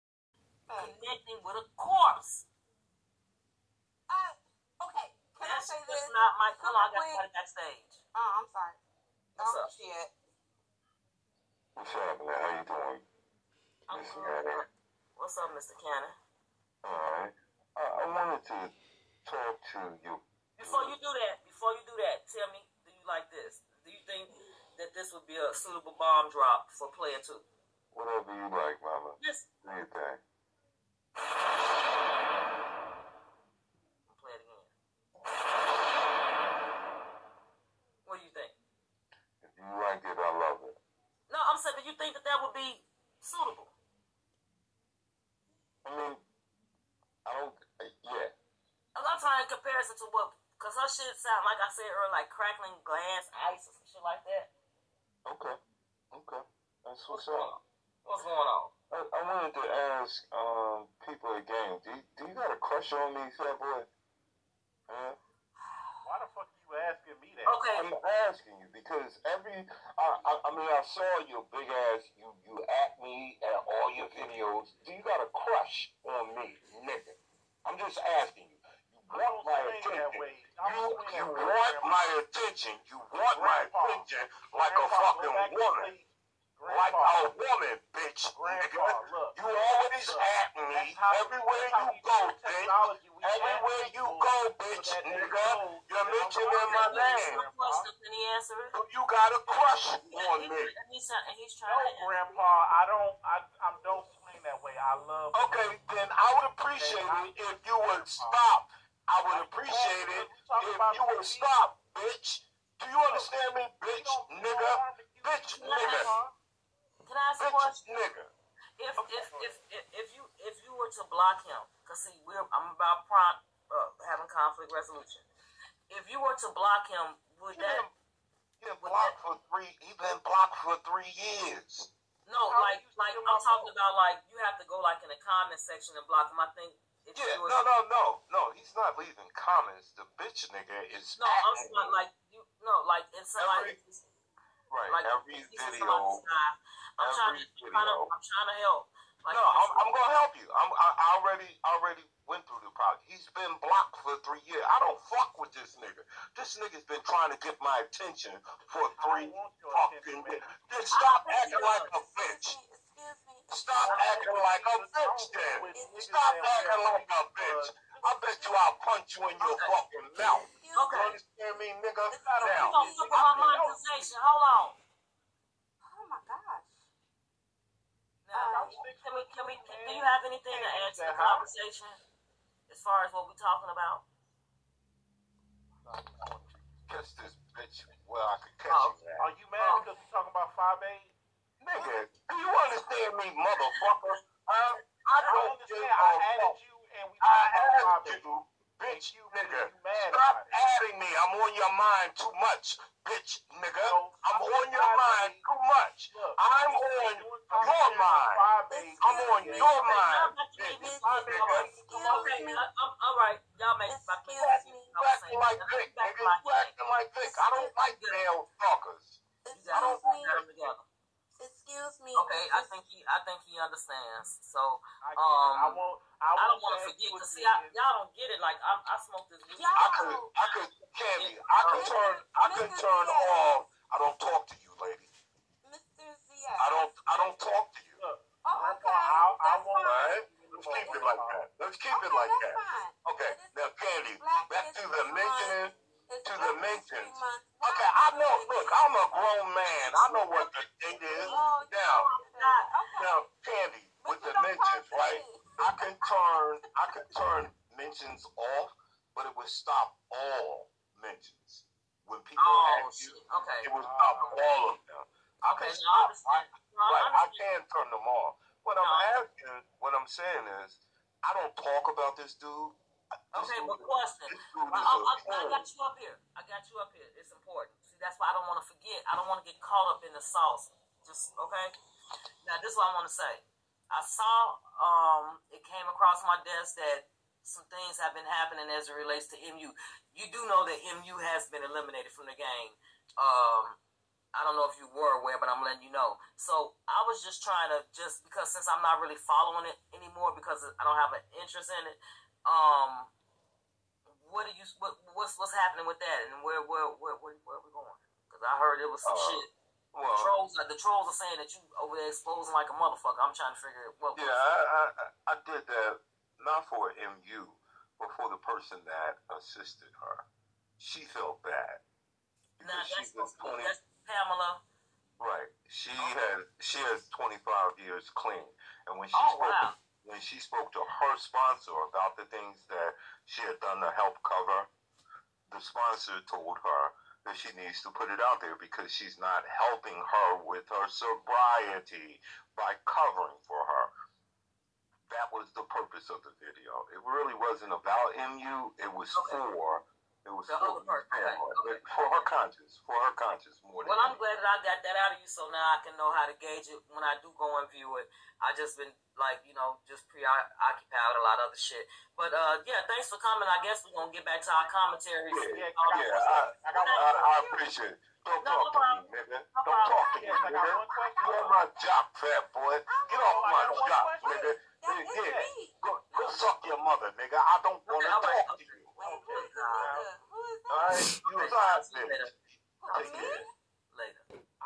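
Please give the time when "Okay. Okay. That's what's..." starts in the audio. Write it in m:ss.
0:55.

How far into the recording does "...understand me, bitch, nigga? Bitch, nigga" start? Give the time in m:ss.
1:52.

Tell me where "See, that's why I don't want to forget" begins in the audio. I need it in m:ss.
4:37.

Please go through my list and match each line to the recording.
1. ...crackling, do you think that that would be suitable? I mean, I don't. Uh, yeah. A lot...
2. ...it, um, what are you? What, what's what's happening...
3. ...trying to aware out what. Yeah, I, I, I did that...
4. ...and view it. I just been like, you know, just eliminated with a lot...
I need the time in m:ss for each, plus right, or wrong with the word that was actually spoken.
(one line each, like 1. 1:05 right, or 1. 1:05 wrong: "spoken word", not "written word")
1. 0:41 wrong: "saying", not "crackling"
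2. 5:01 right
3. 5:13 wrong: "figure", not "aware"
4. 5:57 wrong: "preoccupied", not "eliminated".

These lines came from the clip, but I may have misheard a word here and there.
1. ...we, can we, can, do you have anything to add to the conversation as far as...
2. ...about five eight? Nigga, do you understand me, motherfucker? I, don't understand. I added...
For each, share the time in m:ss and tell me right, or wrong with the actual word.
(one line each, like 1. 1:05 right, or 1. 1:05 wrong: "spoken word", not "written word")
1. 2:58 right
2. 3:10 right.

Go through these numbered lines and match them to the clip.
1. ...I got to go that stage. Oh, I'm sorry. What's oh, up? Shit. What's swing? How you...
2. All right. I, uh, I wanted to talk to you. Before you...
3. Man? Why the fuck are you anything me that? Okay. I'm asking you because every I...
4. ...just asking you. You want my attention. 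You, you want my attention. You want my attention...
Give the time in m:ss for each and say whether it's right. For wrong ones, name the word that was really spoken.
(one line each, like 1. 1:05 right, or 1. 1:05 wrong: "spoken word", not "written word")
1. 0:06 wrong: "happening", not "swing"
2. 0:16 right
3. 1:04 wrong: "asking", not "anything"
4. 1:17 right.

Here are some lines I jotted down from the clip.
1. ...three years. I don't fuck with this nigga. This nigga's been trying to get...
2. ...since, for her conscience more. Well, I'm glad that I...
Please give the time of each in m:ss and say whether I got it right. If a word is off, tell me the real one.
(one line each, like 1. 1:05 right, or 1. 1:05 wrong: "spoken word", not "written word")
1. 2:34 right
2. 5:52 wrong: "conscience", not "since".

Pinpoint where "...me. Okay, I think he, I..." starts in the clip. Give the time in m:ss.
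3:42.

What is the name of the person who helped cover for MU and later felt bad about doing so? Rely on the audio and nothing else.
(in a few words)
Pamela.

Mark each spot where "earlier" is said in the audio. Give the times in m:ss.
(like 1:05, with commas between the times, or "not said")
0:51.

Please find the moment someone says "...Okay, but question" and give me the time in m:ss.
4:33.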